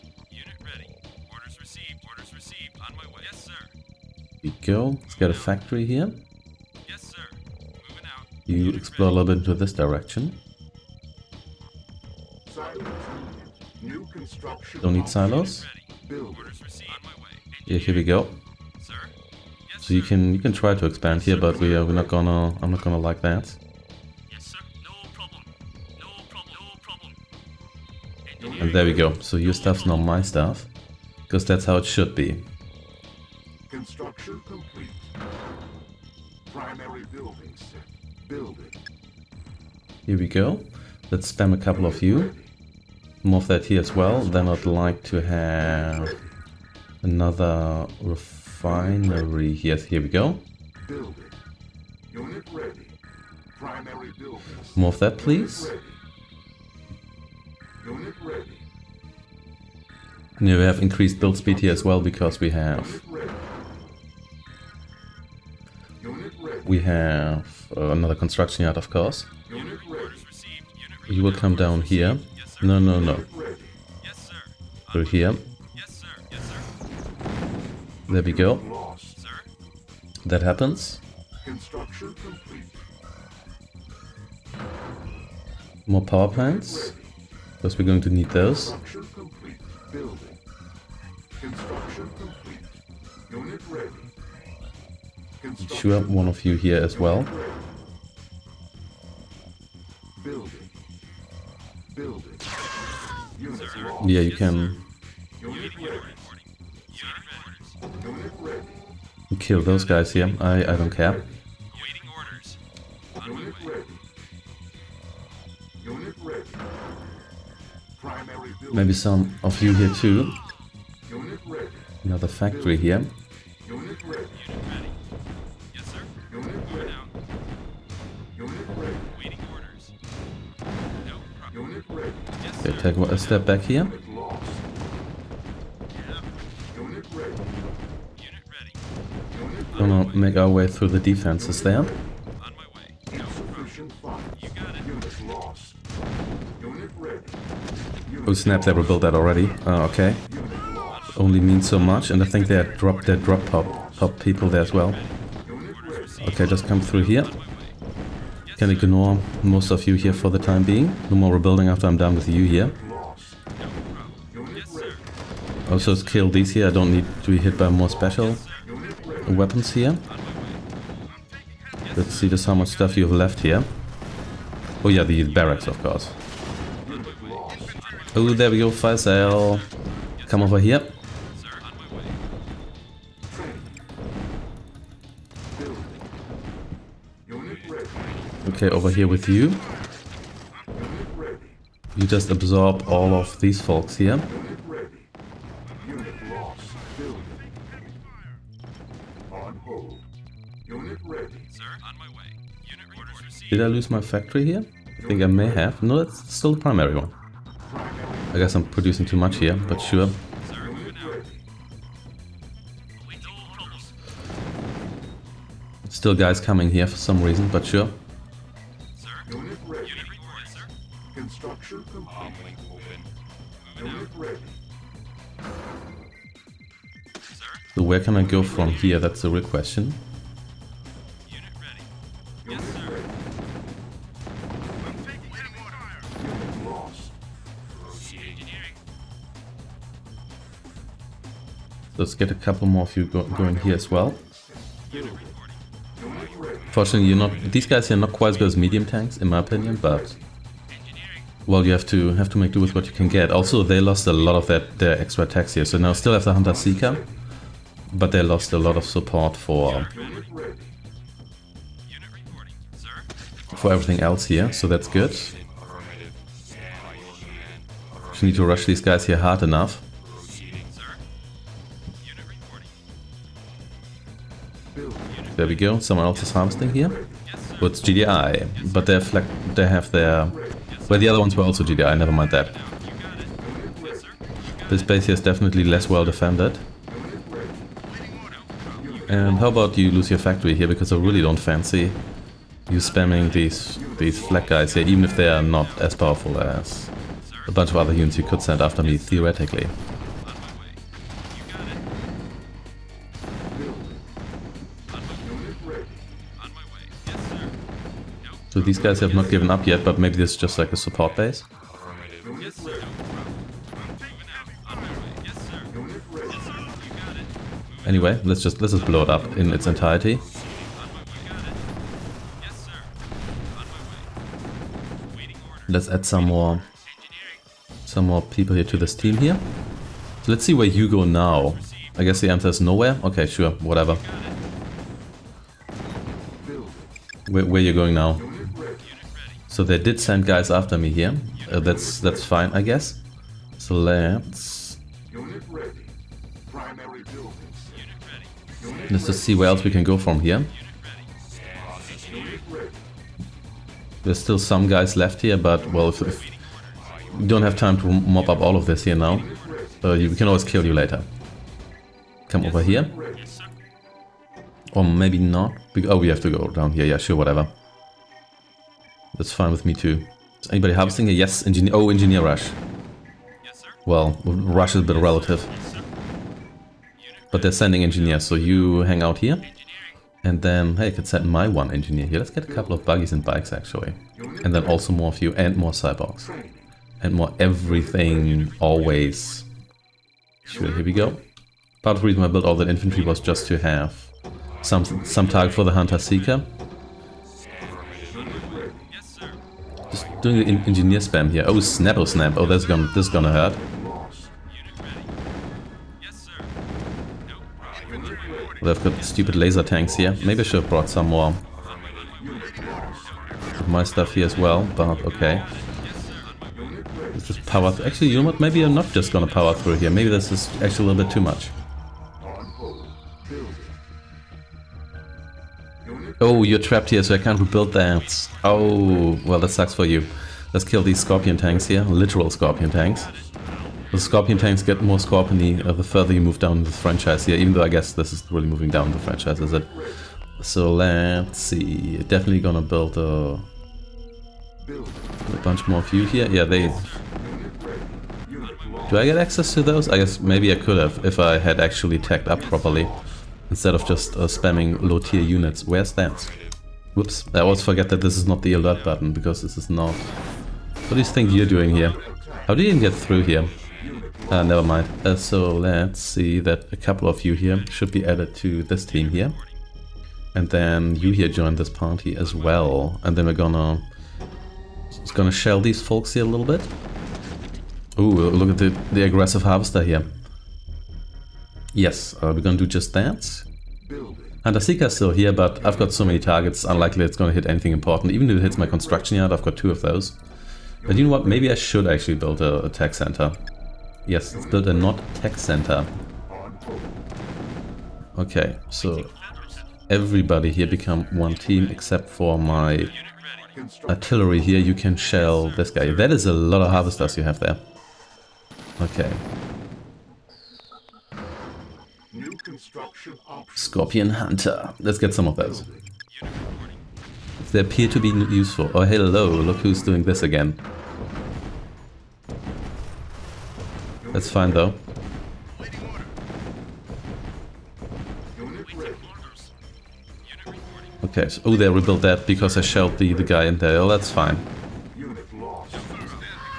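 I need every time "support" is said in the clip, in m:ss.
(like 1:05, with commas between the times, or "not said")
4:18, 5:10.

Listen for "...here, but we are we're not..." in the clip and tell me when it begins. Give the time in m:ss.
0:21.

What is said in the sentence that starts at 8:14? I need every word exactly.
Yes, let's build a Nod tech center.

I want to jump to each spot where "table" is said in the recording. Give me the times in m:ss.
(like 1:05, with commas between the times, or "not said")
not said.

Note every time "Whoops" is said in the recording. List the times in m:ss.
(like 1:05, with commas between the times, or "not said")
7:36.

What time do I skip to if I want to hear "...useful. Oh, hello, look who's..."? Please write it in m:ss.
8:38.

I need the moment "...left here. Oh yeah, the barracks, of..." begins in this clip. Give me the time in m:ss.
2:53.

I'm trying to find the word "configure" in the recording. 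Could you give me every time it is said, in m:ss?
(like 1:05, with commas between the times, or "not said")
not said.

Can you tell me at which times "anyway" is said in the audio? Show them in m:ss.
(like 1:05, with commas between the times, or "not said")
5:17.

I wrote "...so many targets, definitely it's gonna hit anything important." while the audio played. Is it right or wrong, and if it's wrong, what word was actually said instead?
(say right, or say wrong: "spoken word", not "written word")
wrong: "unlikely", not "definitely".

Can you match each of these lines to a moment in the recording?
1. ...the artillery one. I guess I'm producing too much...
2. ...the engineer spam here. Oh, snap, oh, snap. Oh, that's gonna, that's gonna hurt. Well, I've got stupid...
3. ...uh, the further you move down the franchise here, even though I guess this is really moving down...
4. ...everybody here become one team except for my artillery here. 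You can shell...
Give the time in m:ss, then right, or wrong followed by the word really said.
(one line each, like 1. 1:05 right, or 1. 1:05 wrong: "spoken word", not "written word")
1. 3:26 wrong: "primary", not "artillery"
2. 6:40 right
3. 7:15 right
4. 8:19 right.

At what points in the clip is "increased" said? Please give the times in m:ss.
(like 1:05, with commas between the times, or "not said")
1:00.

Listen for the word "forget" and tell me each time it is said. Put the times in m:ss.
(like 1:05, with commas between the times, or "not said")
7:37.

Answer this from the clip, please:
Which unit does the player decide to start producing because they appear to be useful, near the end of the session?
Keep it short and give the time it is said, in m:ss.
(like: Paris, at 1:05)
Scorpion Hunter, at 8:33.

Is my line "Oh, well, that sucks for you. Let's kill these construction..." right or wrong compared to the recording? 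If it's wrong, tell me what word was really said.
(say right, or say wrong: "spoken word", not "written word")
wrong: "scorpion", not "construction".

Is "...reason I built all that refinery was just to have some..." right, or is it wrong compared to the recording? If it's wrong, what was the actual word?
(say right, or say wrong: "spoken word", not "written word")
wrong: "infantry", not "refinery".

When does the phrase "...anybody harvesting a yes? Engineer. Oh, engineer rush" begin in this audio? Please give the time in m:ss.
6:10.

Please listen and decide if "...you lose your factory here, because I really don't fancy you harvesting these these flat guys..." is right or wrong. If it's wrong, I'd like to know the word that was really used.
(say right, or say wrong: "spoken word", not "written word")
wrong: "spamming", not "harvesting".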